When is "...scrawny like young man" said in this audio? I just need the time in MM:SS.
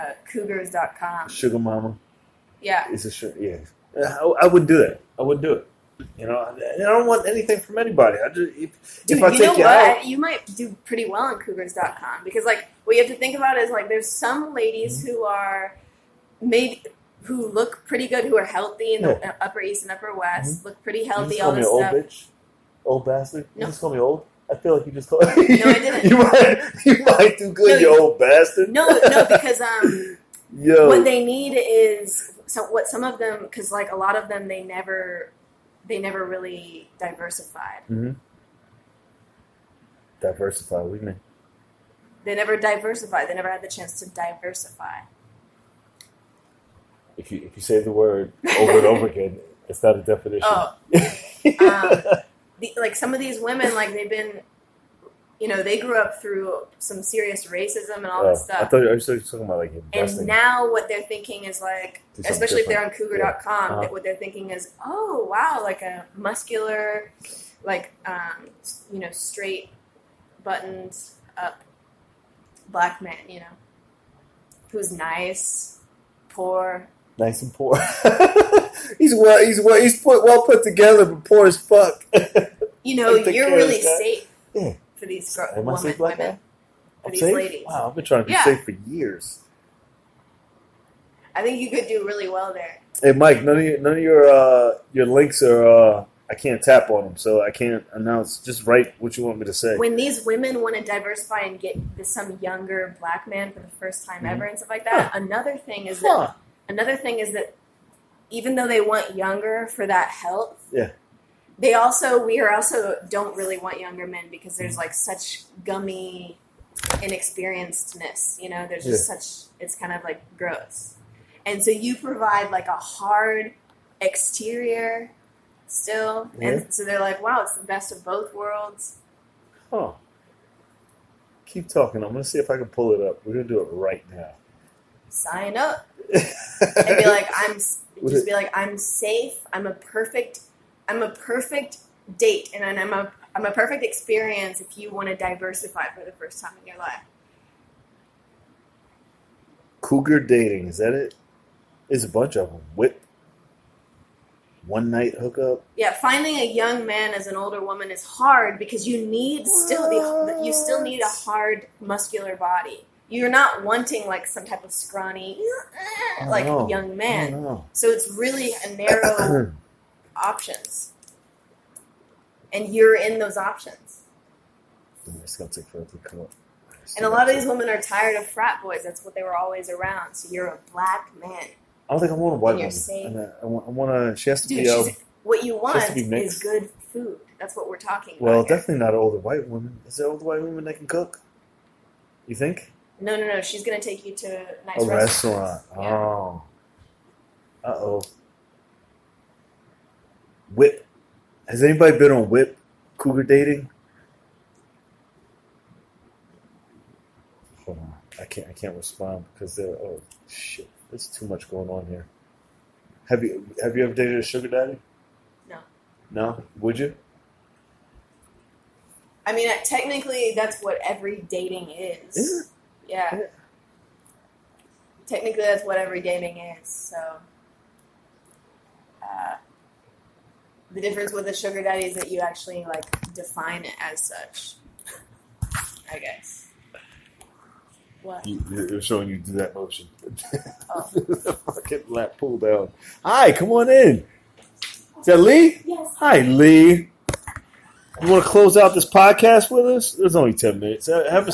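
02:44.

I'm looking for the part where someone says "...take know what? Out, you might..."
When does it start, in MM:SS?
00:09.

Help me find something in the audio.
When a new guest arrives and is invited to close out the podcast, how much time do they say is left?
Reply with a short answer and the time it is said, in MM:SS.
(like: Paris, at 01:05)
10 minutes, at 04:10.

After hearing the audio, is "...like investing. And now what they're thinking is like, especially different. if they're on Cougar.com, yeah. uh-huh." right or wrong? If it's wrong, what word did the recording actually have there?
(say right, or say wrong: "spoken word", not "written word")
right.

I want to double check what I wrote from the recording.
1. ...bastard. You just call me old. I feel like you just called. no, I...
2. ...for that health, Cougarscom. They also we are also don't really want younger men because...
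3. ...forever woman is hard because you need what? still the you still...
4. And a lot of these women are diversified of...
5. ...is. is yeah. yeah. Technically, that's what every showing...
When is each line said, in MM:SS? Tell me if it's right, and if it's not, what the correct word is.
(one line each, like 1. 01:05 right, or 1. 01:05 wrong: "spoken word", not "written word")
1. 00:23 right
2. 01:49 wrong: "Yeah", not "Cougarscom"
3. 02:37 wrong: "older", not "forever"
4. 02:56 wrong: "tired", not "diversified"
5. 03:41 wrong: "dating", not "showing".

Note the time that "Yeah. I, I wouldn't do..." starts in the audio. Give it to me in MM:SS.
00:03.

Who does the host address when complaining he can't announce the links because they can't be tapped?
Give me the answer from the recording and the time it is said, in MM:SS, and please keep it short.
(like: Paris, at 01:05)
Mike, at 01:33.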